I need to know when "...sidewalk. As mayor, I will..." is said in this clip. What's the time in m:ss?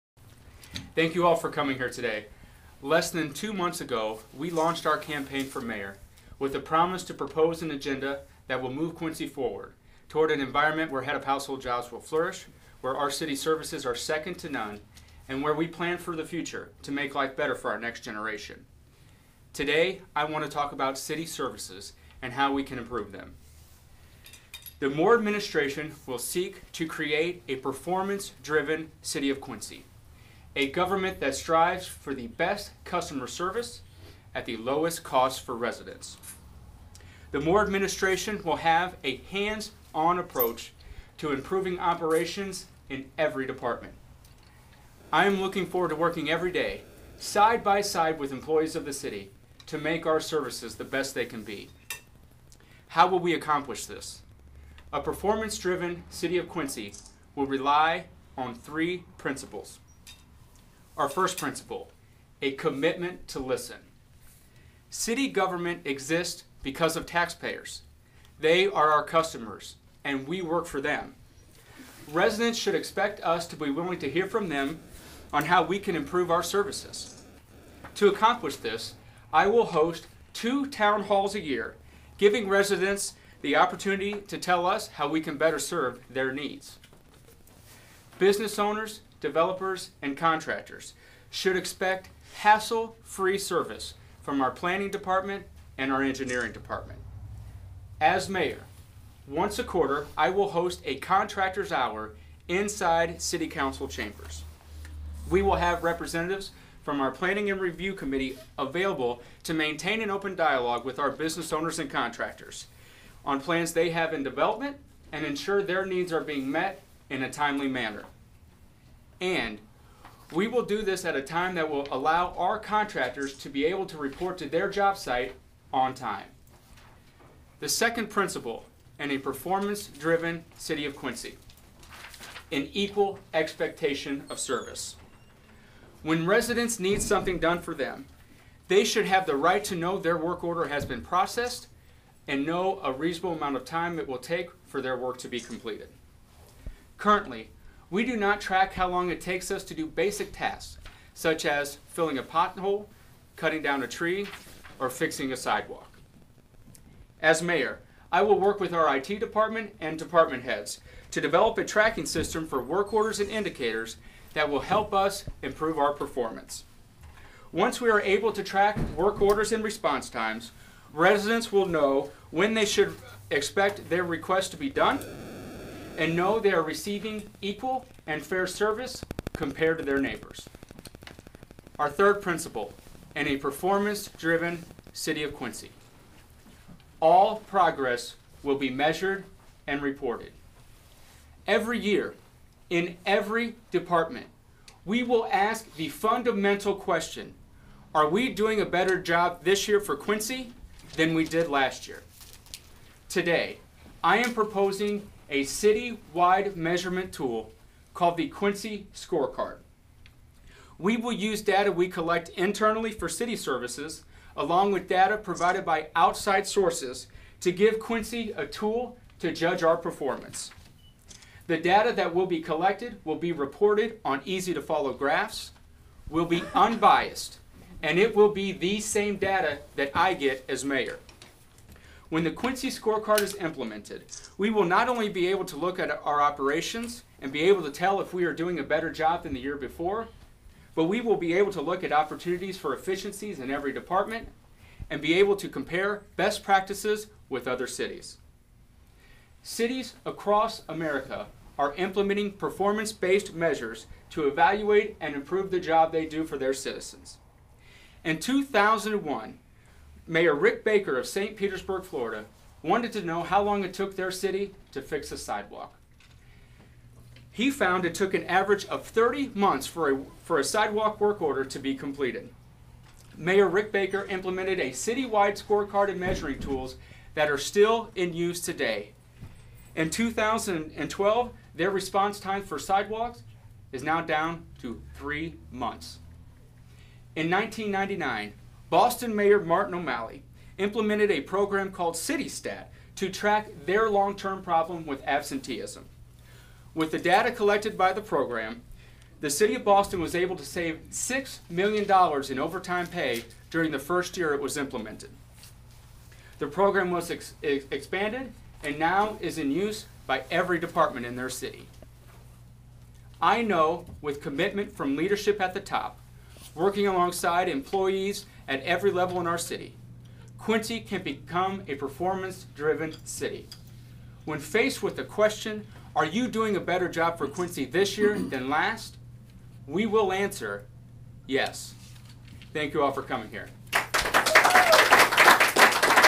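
2:35.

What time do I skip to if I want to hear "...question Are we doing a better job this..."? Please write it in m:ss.
3:16.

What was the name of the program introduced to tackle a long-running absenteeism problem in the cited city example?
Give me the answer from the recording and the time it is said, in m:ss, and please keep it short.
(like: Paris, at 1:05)
CityStat, at 4:51.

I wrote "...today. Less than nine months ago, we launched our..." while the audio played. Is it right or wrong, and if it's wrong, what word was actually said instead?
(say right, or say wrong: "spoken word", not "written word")
wrong: "two", not "nine".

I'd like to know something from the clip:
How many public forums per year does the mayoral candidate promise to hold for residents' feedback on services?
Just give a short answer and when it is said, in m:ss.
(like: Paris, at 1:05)
2, at 1:20.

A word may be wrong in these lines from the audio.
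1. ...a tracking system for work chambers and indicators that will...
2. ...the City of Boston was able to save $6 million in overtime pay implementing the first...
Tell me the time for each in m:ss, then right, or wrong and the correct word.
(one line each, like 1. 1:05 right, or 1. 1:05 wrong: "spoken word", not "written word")
1. 2:41 wrong: "orders", not "chambers"
2. 4:59 wrong: "during", not "implementing".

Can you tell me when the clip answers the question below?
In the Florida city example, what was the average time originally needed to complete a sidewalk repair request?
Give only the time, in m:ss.
4:28.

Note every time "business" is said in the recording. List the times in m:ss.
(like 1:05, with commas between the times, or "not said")
1:28, 1:51.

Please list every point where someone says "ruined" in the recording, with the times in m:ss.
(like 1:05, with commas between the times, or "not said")
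not said.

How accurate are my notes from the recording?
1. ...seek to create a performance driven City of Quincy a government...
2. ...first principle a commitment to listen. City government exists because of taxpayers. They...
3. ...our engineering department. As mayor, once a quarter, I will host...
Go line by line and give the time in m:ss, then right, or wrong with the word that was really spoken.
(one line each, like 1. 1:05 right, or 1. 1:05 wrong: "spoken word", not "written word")
1. 0:26 right
2. 1:01 right
3. 1:35 right.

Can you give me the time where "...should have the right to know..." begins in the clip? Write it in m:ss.
2:18.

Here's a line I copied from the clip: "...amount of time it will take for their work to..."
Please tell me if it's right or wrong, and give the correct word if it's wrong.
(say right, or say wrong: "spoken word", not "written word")
right.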